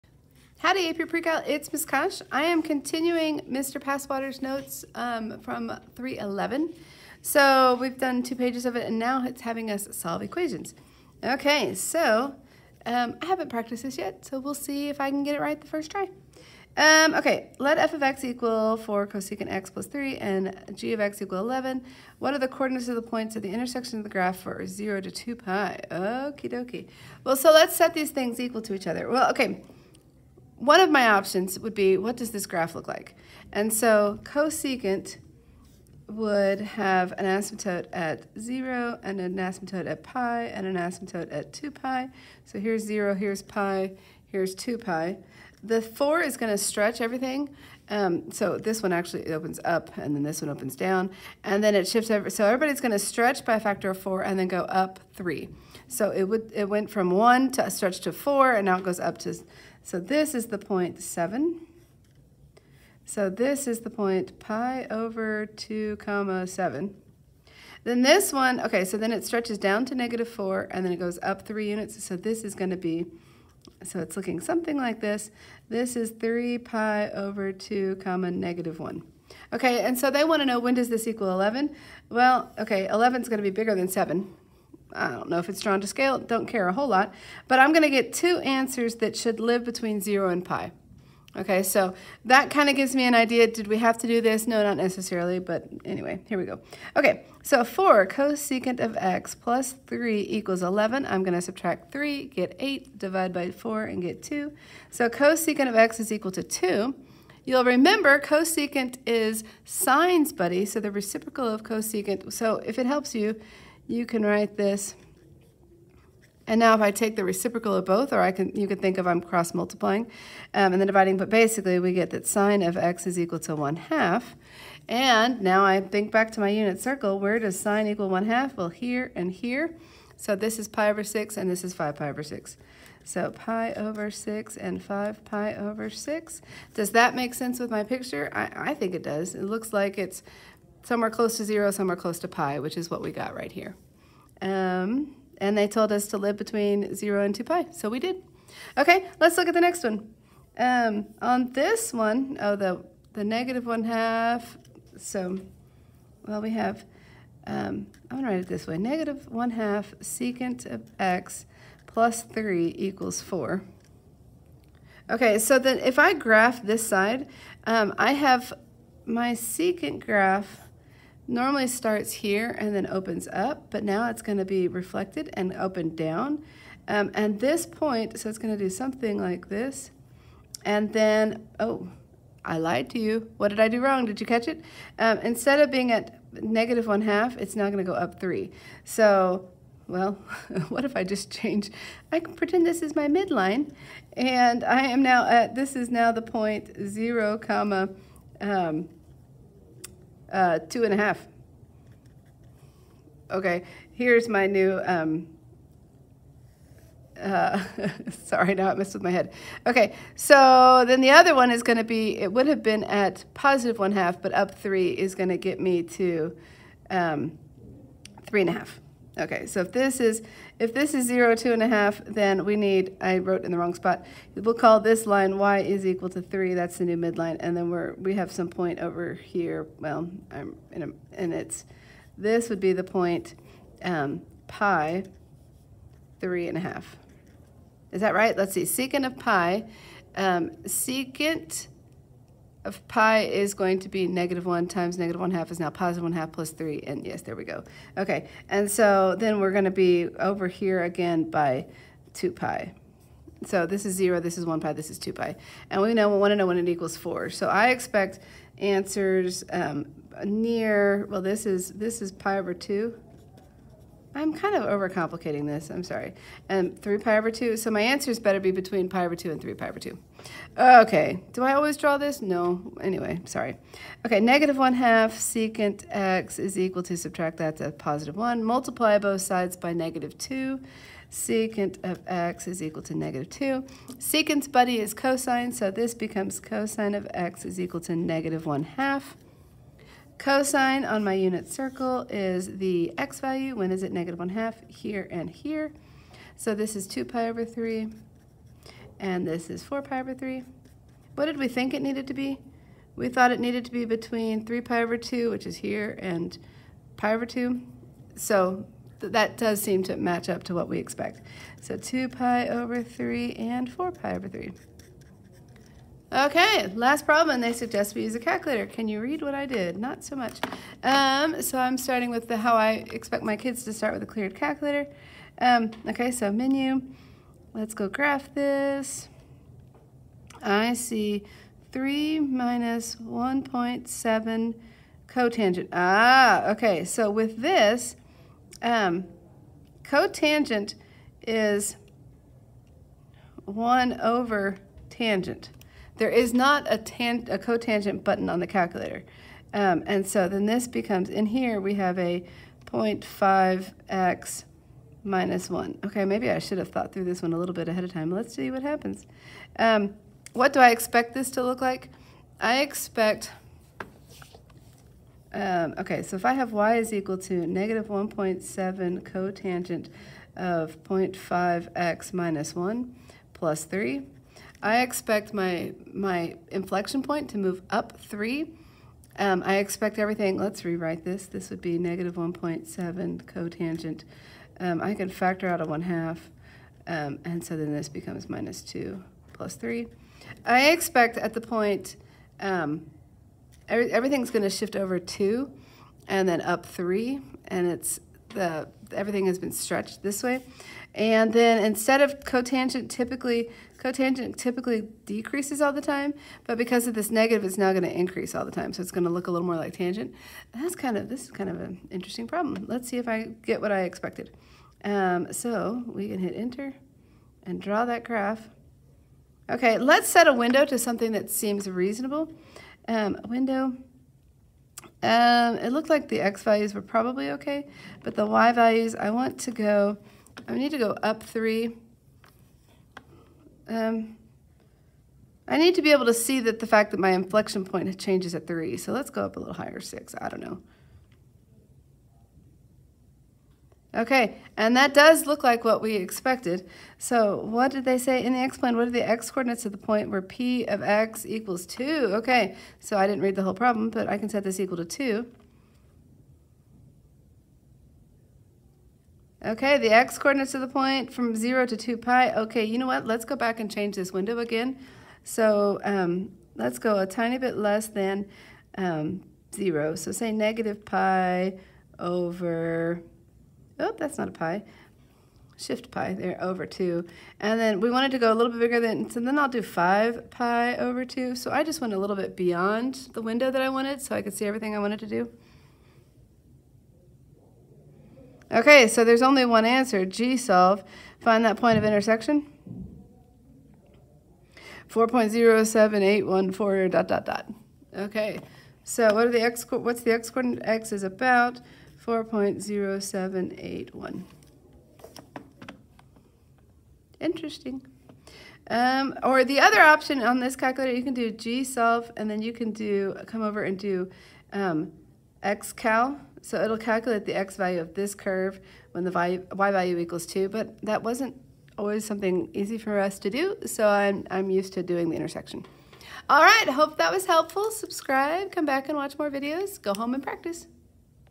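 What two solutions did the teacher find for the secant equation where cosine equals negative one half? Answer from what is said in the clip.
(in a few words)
2 pi/3 and 4 pi/3.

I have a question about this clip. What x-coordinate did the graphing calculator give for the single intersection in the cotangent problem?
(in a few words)
About 4.0781.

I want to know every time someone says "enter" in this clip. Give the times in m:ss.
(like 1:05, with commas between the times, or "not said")
6:56.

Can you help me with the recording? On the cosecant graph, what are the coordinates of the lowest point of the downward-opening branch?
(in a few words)
3 pi over 2, -1.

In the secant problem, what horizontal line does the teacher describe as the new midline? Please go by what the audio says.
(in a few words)
y = 3.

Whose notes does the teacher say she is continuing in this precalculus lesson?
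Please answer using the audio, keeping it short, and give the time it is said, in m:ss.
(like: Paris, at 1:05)
Mr. Passwater, at 0:03.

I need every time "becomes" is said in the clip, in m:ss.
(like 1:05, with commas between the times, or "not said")
4:45, 5:50, 6:27.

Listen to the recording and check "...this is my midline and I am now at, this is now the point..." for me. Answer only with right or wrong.
right.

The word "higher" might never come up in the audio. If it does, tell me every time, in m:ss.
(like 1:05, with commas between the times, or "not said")
7:19.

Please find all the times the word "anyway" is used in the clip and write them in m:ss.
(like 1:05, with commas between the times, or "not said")
1:35, 4:32.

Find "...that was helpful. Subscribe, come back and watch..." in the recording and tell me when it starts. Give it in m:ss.
8:46.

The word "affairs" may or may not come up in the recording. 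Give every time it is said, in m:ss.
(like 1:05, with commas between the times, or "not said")
not said.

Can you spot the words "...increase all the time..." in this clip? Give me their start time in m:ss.
6:47.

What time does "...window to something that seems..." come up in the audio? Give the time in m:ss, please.
7:00.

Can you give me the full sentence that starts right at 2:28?
Okay, let's look at the next one.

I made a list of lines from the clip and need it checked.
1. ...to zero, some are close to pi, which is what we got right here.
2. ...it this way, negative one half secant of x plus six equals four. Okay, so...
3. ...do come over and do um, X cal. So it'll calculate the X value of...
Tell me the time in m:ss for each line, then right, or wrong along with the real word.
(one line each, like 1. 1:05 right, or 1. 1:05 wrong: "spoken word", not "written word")
1. 2:21 right
2. 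2:38 wrong: "three", not "six"
3. 8:32 right.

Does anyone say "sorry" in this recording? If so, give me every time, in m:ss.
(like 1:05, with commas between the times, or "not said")
3:28, 4:25, 4:33.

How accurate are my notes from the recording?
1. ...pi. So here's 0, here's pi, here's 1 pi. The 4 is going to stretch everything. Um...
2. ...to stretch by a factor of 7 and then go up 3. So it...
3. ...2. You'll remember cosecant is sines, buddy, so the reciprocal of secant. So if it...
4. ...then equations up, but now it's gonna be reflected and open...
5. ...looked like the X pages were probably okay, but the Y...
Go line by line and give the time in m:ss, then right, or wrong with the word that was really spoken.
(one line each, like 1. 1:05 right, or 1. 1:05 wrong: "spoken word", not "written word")
1. 0:41 wrong: "2", not "1"
2. 0:52 wrong: "4", not "7"
3. 1:46 wrong: "cosecant", not "secant"
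4. 2:52 wrong: "opens", not "equations"
5. 7:05 wrong: "values", not "pages".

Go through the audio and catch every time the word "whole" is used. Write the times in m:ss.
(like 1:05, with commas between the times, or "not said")
1:26, 7:33.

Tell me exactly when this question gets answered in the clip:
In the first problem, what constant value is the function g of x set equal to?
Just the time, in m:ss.
0:20.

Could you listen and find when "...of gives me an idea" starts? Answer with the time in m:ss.
1:32.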